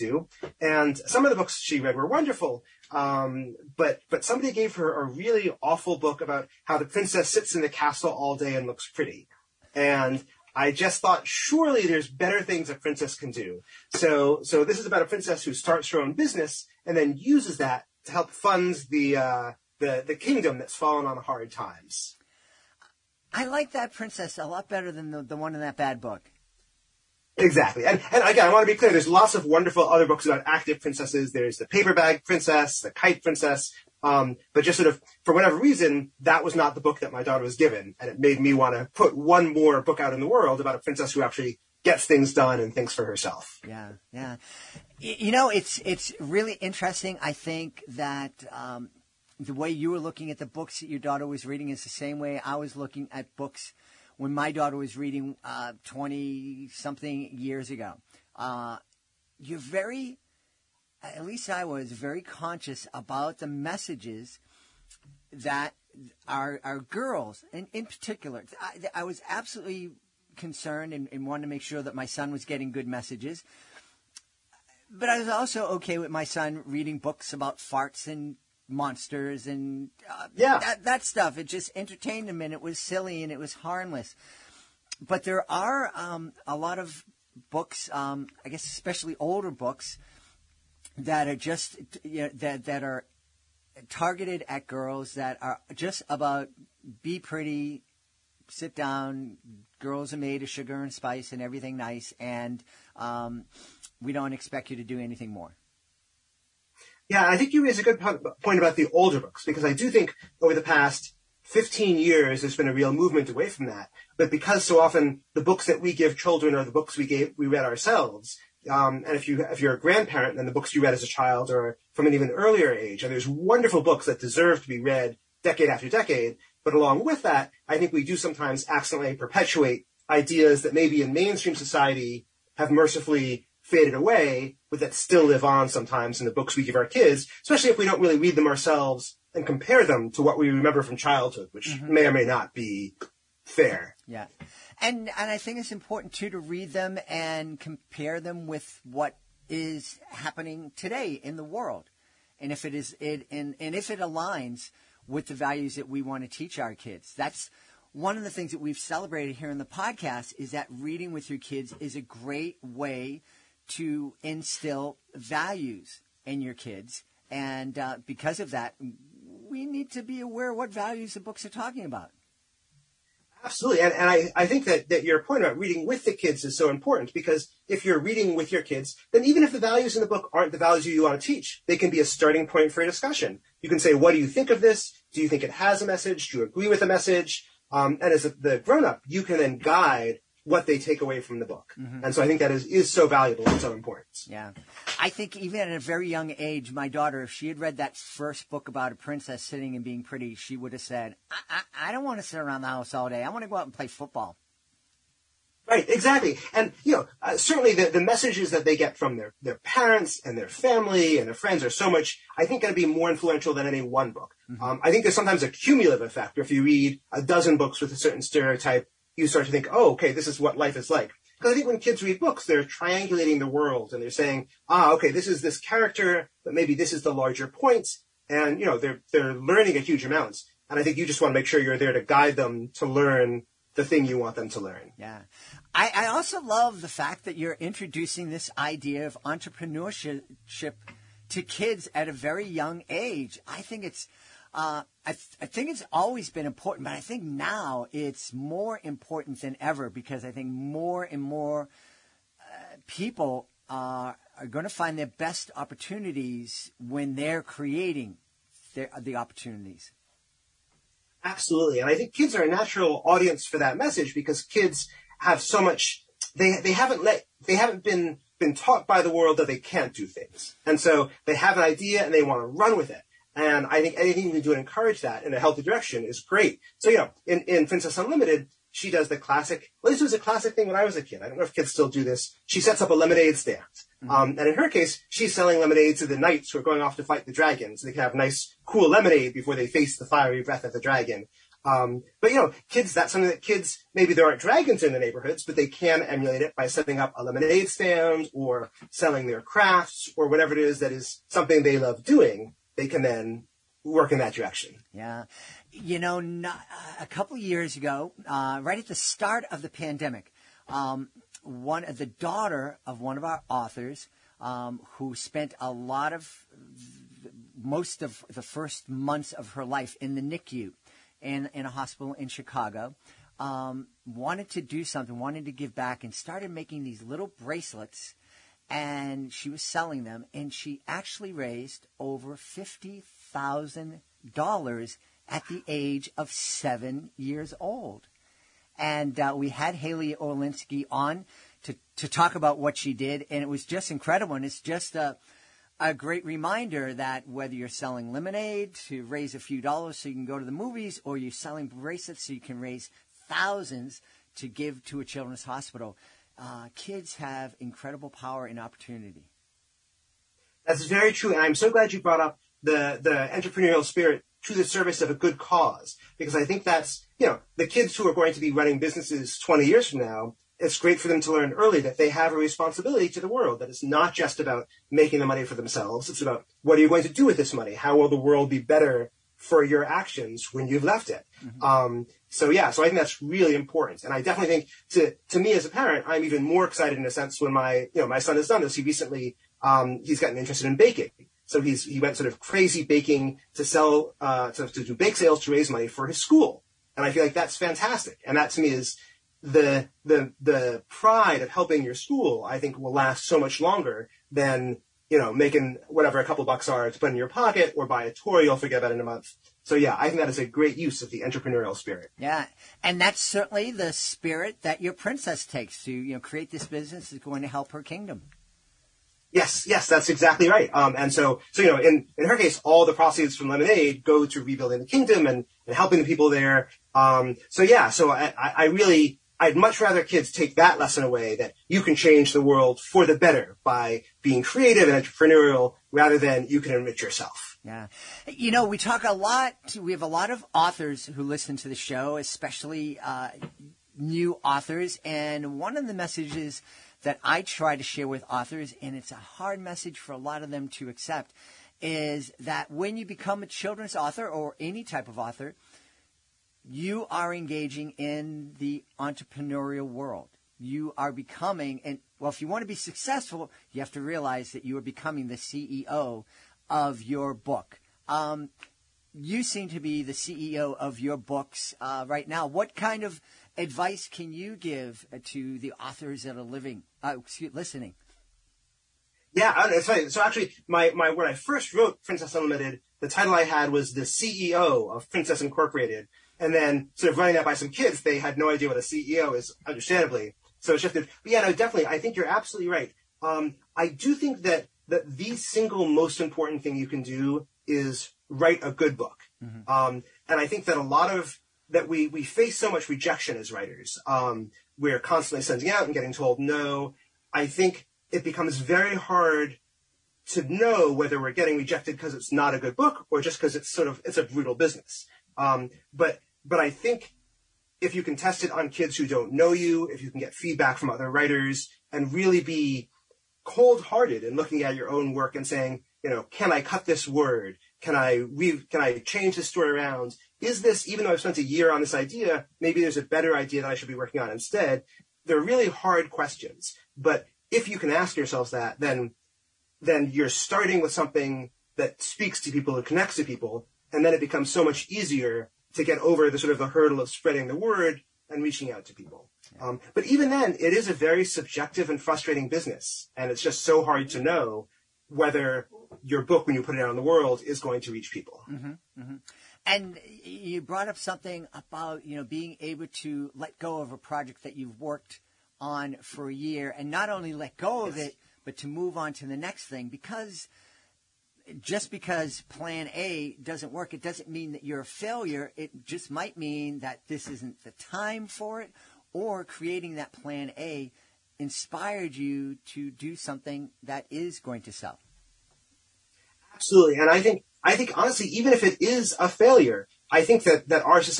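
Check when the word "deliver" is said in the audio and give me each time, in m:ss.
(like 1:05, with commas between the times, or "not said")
not said.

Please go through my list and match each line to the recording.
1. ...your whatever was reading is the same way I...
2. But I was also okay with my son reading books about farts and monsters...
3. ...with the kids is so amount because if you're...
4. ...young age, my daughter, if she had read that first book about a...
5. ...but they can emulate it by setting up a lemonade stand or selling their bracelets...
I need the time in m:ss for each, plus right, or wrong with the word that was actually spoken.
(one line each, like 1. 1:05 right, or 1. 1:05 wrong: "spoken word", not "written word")
1. 0:50 wrong: "daughter", not "whatever"
2. 1:14 right
3. 2:55 wrong: "important", not "amount"
4. 3:16 right
5. 4:55 wrong: "crafts", not "bracelets".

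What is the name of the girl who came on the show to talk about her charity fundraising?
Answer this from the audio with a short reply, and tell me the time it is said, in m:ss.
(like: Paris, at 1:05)
Haley Olinsky, at 5:39.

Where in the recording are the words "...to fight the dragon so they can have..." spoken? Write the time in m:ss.
4:46.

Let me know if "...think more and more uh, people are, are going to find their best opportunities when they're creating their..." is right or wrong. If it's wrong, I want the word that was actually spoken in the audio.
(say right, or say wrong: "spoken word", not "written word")
right.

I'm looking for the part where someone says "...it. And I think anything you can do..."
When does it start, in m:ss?
4:32.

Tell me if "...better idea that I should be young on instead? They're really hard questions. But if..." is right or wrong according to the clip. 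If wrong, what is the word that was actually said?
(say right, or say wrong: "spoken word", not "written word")
wrong: "working", not "young".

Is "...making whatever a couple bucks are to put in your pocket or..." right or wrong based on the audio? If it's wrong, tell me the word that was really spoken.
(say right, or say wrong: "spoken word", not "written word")
right.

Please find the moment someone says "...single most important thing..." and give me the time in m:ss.
8:15.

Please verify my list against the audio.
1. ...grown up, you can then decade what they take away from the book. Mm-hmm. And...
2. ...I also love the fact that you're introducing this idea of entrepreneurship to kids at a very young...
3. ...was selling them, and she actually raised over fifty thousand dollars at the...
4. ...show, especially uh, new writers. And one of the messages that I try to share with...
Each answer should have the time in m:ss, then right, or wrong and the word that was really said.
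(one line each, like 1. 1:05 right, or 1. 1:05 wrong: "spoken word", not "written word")
1. 3:08 wrong: "guide", not "decade"
2. 3:55 right
3. 5:29 right
4. 7:21 wrong: "authors", not "writers".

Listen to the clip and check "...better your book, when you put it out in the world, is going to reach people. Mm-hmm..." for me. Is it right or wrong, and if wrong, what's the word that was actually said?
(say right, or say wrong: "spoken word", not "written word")
wrong: "whether", not "better".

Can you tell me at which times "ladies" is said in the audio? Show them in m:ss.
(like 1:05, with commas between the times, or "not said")
not said.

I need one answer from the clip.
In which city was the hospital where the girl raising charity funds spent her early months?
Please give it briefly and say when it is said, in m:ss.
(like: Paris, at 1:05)
Chicago, at 5:22.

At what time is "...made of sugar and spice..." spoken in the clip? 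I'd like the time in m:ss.
1:40.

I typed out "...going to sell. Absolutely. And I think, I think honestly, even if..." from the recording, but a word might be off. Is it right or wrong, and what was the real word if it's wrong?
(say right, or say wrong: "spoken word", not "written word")
right.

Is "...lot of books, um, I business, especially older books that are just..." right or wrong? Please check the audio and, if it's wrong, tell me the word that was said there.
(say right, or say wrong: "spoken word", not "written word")
wrong: "guess", not "business".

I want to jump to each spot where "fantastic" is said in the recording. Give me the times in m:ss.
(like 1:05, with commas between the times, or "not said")
6:37.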